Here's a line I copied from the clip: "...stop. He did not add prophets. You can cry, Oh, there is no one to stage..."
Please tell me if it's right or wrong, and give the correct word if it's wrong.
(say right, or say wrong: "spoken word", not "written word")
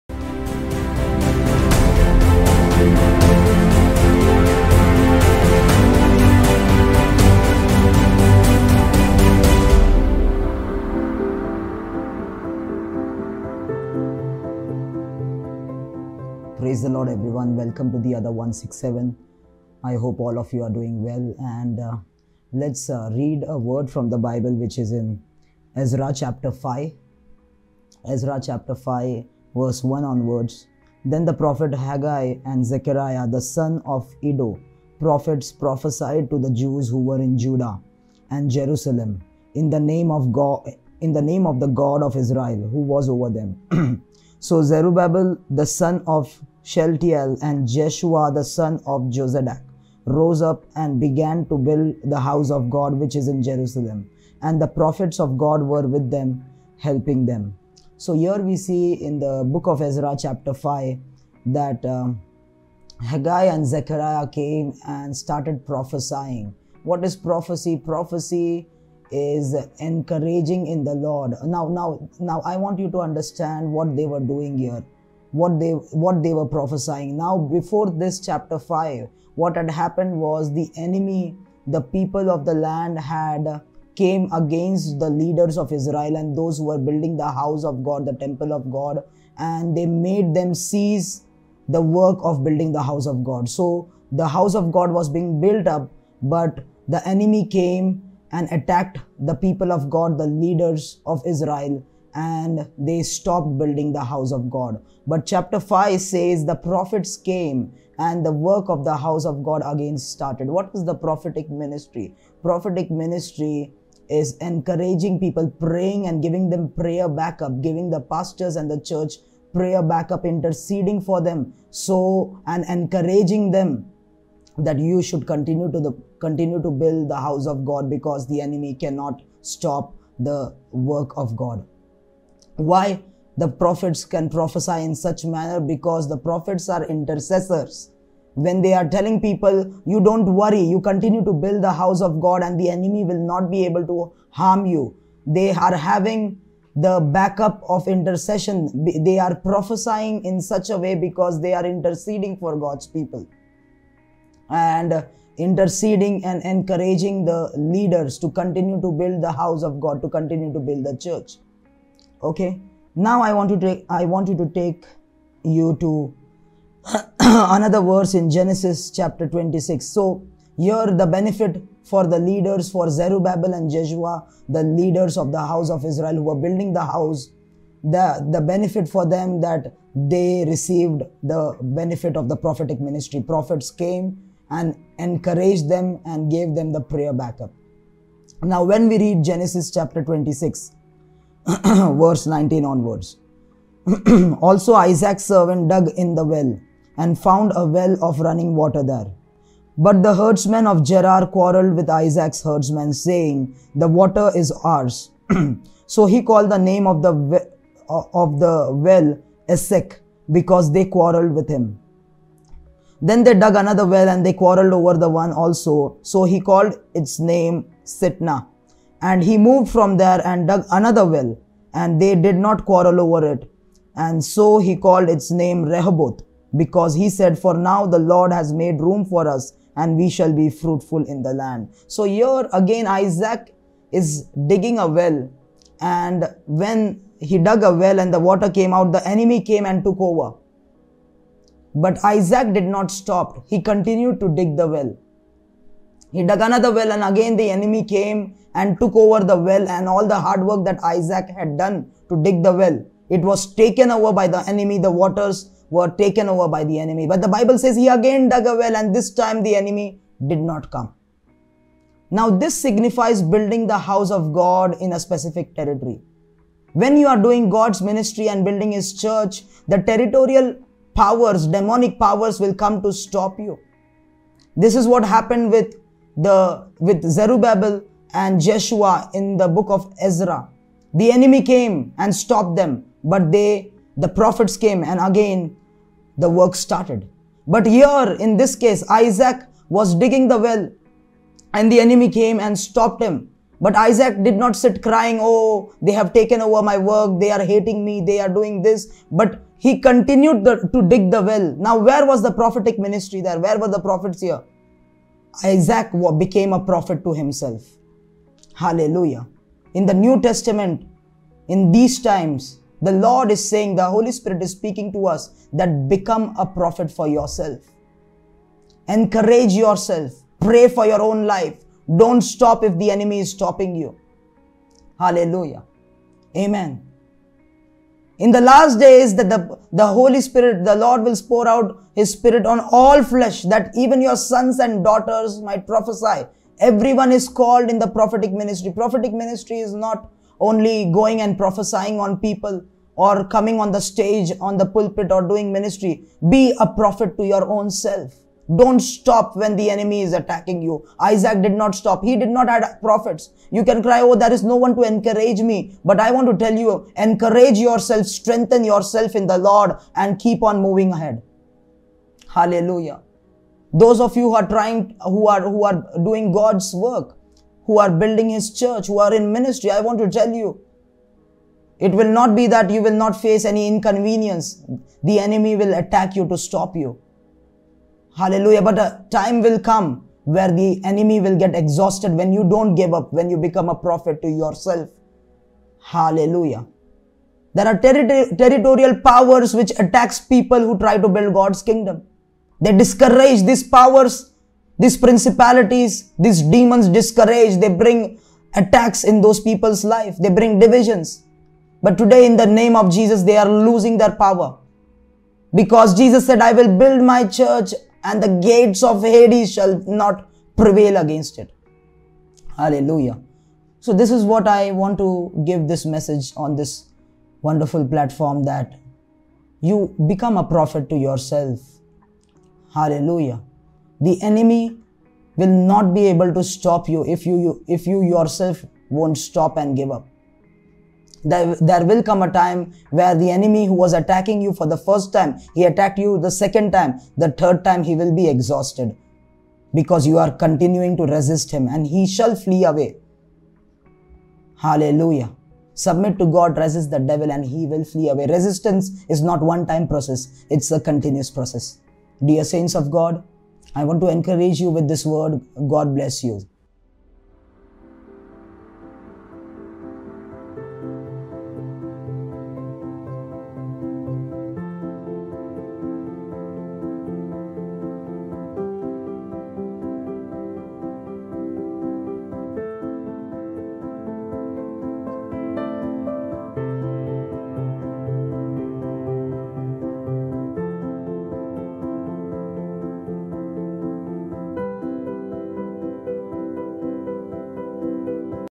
wrong: "encourage", not "stage".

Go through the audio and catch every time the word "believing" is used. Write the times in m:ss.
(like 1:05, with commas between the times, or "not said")
not said.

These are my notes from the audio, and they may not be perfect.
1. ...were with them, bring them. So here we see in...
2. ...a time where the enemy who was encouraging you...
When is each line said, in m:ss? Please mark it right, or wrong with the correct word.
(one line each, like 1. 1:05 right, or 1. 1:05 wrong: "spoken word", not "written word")
1. 0:55 wrong: "helping", not "bring"
2. 7:12 wrong: "attacking", not "encouraging".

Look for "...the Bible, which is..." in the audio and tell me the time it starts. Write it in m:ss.
0:24.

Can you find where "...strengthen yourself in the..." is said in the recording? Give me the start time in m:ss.
5:58.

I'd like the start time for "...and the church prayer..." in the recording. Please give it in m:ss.
1:58.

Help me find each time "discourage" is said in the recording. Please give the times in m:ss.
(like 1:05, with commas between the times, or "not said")
6:32, 6:36.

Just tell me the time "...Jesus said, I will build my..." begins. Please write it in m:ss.
6:45.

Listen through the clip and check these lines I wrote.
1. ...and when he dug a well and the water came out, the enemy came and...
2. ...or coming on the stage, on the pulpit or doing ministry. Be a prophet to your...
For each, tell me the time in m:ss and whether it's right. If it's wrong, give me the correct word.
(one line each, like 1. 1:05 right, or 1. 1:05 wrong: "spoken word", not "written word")
1. 3:55 right
2. 5:42 right.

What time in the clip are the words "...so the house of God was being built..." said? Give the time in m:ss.
1:33.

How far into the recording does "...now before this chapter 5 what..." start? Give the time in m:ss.
1:17.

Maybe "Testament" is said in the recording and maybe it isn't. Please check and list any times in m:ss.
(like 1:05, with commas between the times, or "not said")
5:10.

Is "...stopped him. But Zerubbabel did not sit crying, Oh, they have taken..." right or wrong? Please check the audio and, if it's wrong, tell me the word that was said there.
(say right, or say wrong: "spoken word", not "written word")
wrong: "Isaac", not "Zerubbabel".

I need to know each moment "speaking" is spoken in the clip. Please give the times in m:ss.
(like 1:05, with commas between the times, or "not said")
5:14.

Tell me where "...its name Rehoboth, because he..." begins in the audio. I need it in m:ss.
3:45.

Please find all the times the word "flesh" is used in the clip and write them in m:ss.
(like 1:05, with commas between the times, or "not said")
5:33.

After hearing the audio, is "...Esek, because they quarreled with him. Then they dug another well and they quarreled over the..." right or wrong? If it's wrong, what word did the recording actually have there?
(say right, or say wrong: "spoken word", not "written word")
right.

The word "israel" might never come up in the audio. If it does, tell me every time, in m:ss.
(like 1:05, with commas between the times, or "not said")
0:42, 1:25, 1:41, 2:55.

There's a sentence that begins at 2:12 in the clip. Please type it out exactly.
Why the prophets can prophesy in such manner?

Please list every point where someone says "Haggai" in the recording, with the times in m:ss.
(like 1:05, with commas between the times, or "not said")
0:31, 1:03.